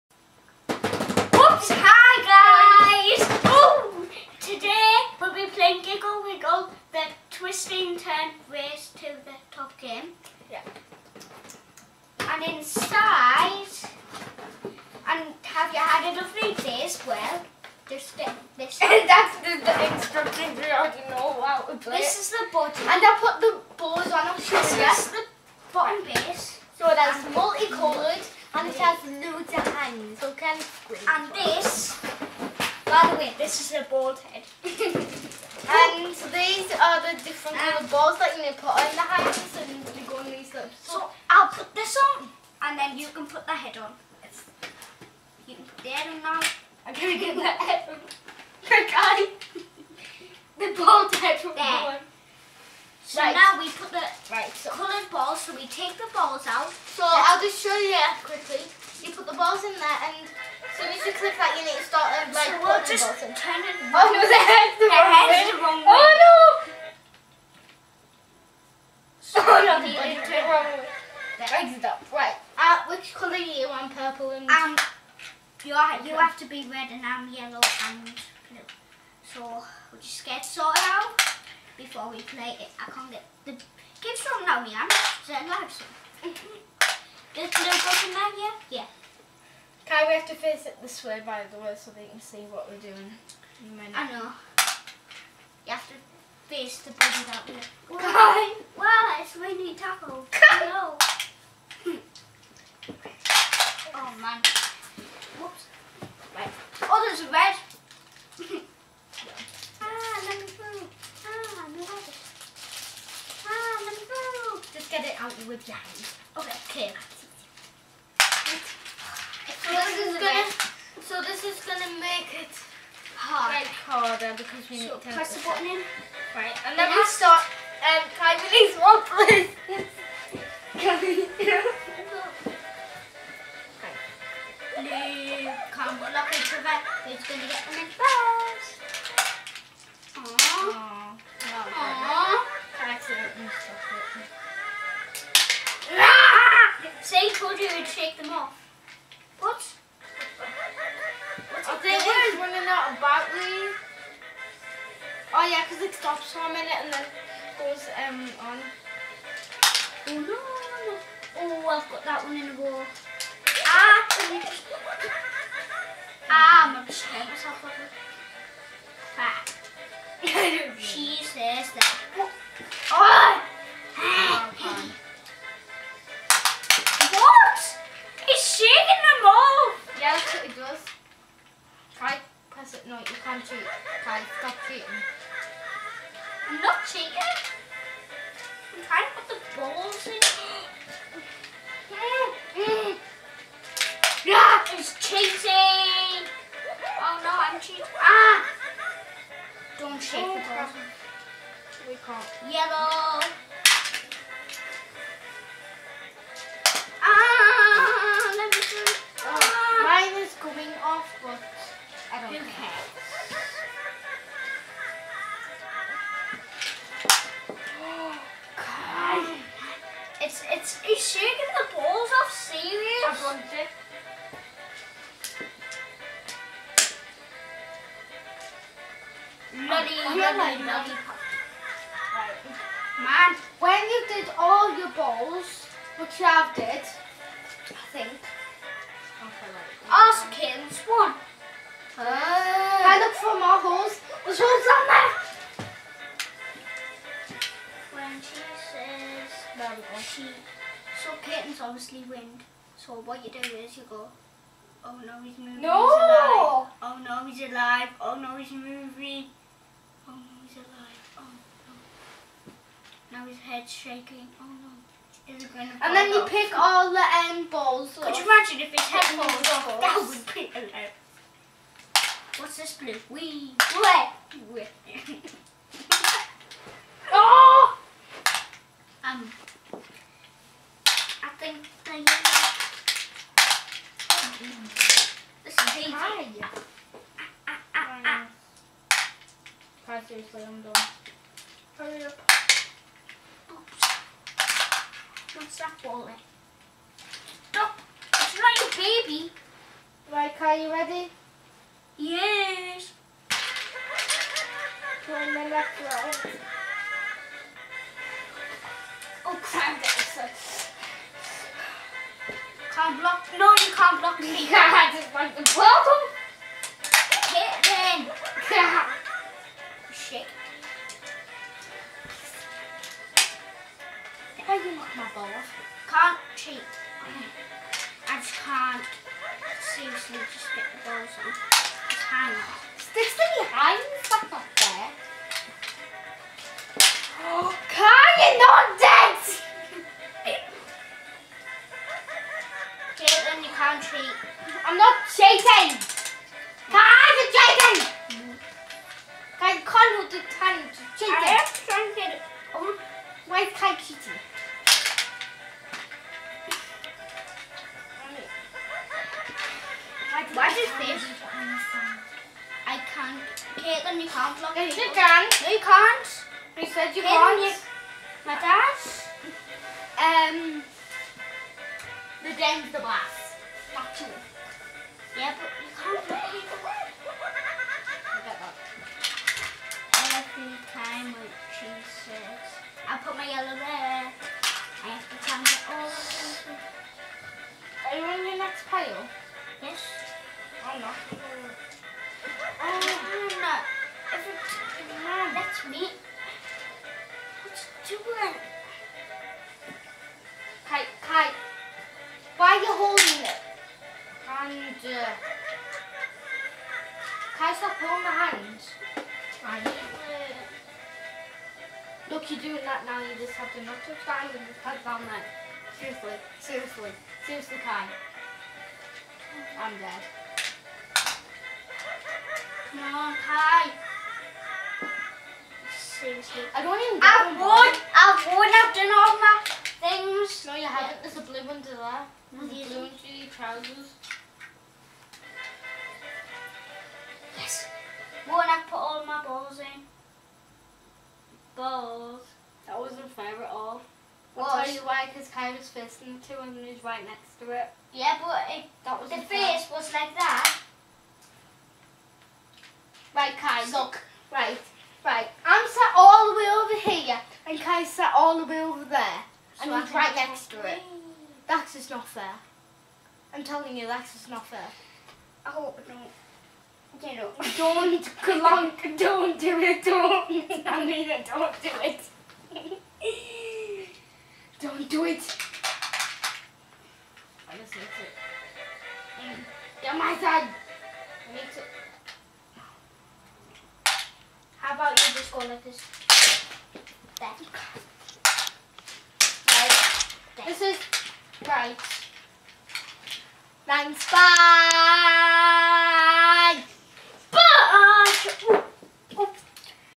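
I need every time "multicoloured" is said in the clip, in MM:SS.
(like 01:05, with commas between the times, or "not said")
00:27.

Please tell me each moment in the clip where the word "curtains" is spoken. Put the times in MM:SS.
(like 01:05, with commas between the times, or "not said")
04:11.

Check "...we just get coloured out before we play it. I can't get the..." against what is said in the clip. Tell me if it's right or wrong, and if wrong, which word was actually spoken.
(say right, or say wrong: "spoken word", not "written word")
wrong: "sorted", not "coloured".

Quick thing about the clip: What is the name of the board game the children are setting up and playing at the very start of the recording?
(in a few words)
Giggle Wiggle.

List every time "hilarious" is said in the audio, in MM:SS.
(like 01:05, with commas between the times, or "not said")
04:30.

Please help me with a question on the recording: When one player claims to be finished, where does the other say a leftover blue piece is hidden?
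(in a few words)
under trousers.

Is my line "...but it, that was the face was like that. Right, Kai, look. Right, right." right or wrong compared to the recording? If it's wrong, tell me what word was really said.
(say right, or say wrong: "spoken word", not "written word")
right.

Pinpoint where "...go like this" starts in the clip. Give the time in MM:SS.
08:05.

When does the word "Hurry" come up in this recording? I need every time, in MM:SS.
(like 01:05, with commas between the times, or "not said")
04:51.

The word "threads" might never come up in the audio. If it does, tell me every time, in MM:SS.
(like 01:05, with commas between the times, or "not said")
not said.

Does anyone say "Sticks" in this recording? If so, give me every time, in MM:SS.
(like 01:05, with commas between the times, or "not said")
05:32.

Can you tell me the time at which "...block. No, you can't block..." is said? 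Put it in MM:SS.
05:13.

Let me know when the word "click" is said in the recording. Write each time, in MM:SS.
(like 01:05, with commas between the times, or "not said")
01:01.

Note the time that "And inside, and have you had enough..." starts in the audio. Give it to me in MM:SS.
00:12.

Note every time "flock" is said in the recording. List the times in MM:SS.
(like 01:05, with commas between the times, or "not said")
not said.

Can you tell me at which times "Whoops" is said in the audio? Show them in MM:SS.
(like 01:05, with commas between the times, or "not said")
01:45.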